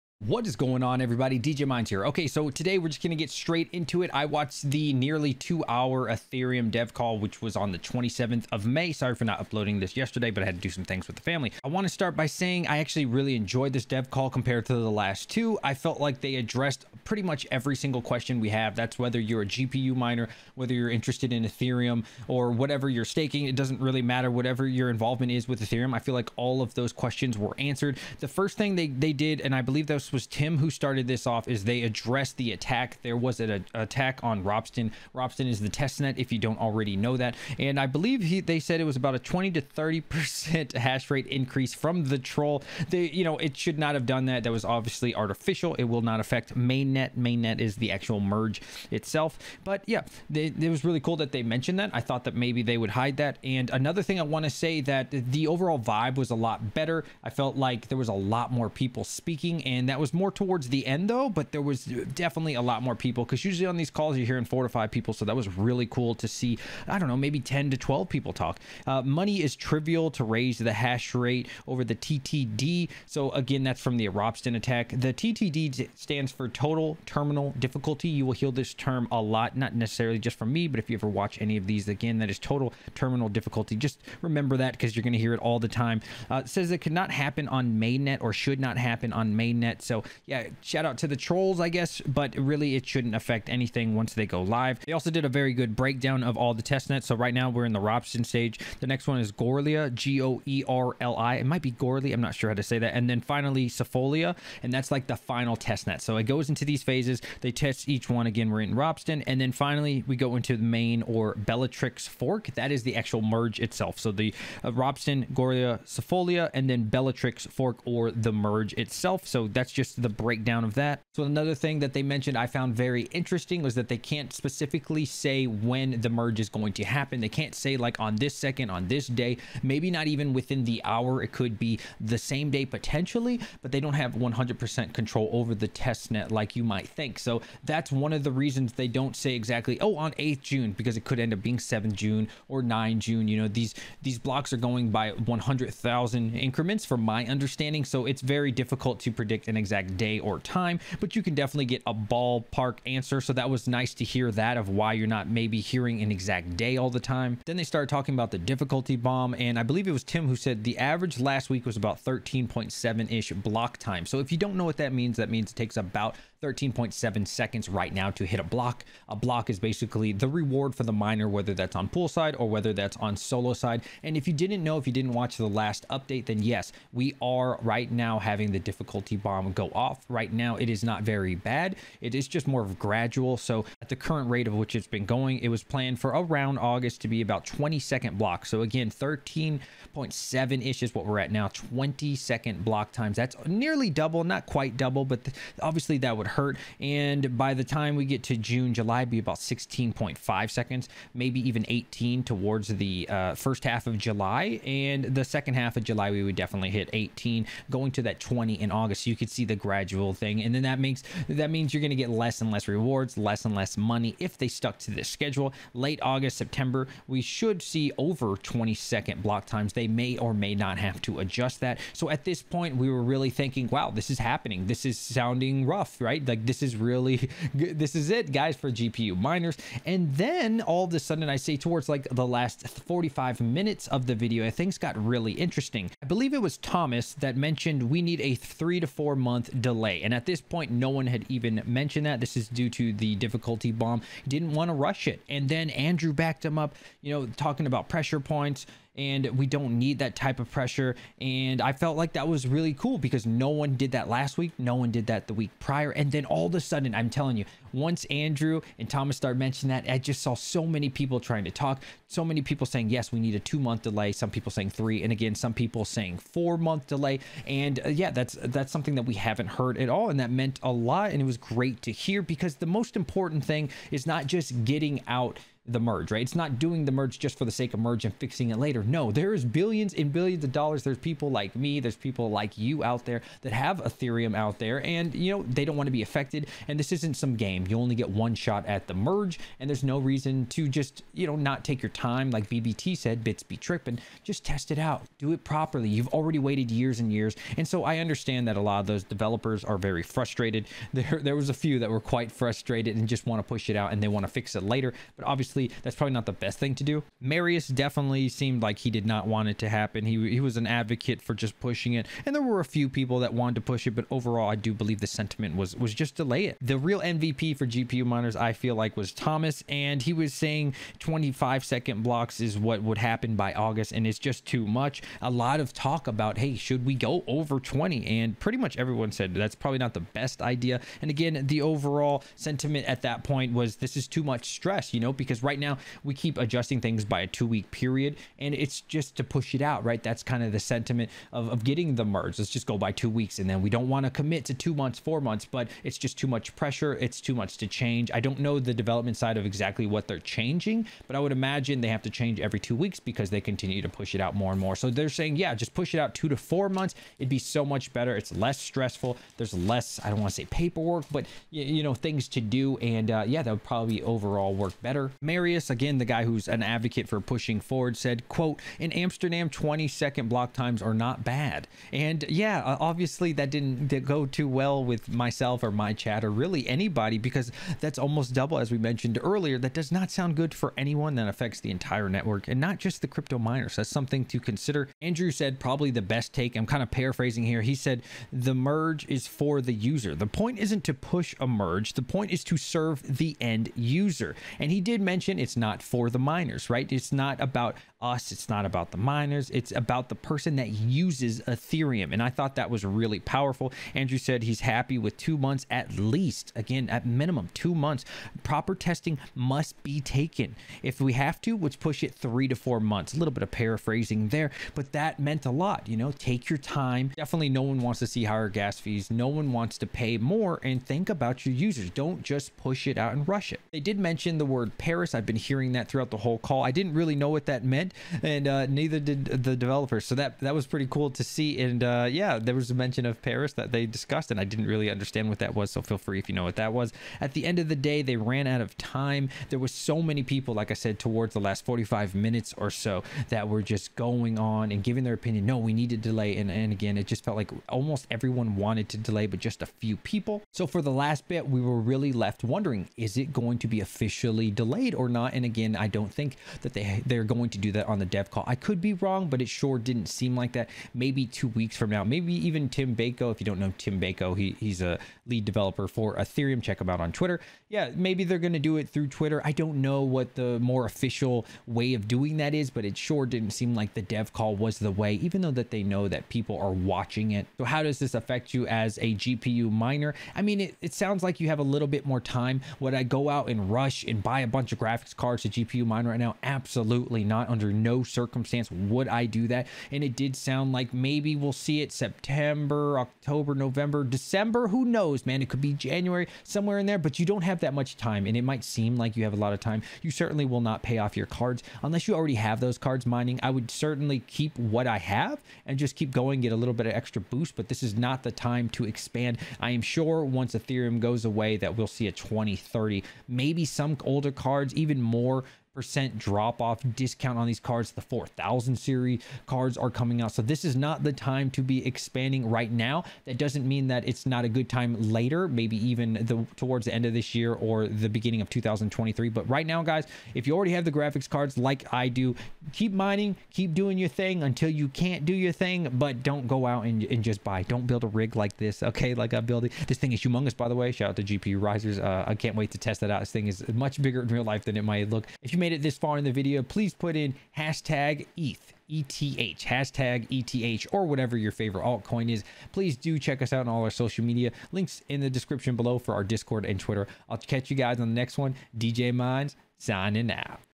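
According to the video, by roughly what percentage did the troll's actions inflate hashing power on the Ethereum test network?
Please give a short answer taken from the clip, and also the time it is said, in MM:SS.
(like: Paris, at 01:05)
20 to 30 percent, at 00:39.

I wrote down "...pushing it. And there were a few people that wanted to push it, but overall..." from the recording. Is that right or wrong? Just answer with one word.
right.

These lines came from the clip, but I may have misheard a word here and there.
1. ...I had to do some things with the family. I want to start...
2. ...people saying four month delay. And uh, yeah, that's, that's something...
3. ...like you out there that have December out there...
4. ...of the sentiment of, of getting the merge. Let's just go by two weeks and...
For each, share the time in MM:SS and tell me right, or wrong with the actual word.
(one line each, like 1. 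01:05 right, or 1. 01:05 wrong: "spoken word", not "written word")
1. 00:10 right
2. 04:25 right
3. 04:42 wrong: "Ethereum", not "December"
4. 05:40 right.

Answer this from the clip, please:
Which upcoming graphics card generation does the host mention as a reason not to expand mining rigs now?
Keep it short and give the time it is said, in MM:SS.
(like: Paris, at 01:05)
4000 series, at 08:38.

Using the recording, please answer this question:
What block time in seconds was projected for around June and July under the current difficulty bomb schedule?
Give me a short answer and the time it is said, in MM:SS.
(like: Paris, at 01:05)
16.5 seconds, at 03:19.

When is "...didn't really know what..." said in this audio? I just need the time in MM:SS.
07:06.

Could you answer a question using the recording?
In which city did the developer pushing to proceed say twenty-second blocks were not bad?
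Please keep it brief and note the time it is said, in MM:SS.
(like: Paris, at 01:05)
Amsterdam, at 06:08.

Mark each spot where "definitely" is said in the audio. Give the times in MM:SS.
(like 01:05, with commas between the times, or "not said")
01:02, 02:31, 03:26, 05:07, 06:57.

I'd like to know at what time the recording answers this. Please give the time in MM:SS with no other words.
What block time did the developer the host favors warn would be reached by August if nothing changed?
05:20.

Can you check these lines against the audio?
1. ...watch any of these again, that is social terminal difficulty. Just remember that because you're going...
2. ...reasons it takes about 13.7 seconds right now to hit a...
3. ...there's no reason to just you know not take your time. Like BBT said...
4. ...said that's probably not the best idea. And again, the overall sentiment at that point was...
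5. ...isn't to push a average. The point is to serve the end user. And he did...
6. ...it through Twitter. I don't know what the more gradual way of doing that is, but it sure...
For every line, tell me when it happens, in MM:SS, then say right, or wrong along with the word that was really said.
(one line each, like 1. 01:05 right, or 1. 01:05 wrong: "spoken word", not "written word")
1. 01:21 wrong: "total", not "social"
2. 02:45 wrong: "means", not "reasons"
3. 04:49 right
4. 05:29 right
5. 06:30 wrong: "merge", not "average"
6. 07:48 wrong: "official", not "gradual".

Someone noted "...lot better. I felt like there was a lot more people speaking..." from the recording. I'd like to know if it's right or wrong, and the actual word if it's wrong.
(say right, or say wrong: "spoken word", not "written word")
right.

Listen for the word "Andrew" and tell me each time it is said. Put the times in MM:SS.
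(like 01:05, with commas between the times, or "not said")
04:05, 04:18, 06:25, 06:43.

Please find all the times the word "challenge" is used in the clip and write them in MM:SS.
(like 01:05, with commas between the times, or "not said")
not said.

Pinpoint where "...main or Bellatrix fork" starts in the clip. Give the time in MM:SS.
01:50.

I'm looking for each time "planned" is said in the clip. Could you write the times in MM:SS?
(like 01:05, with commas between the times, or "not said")
03:05.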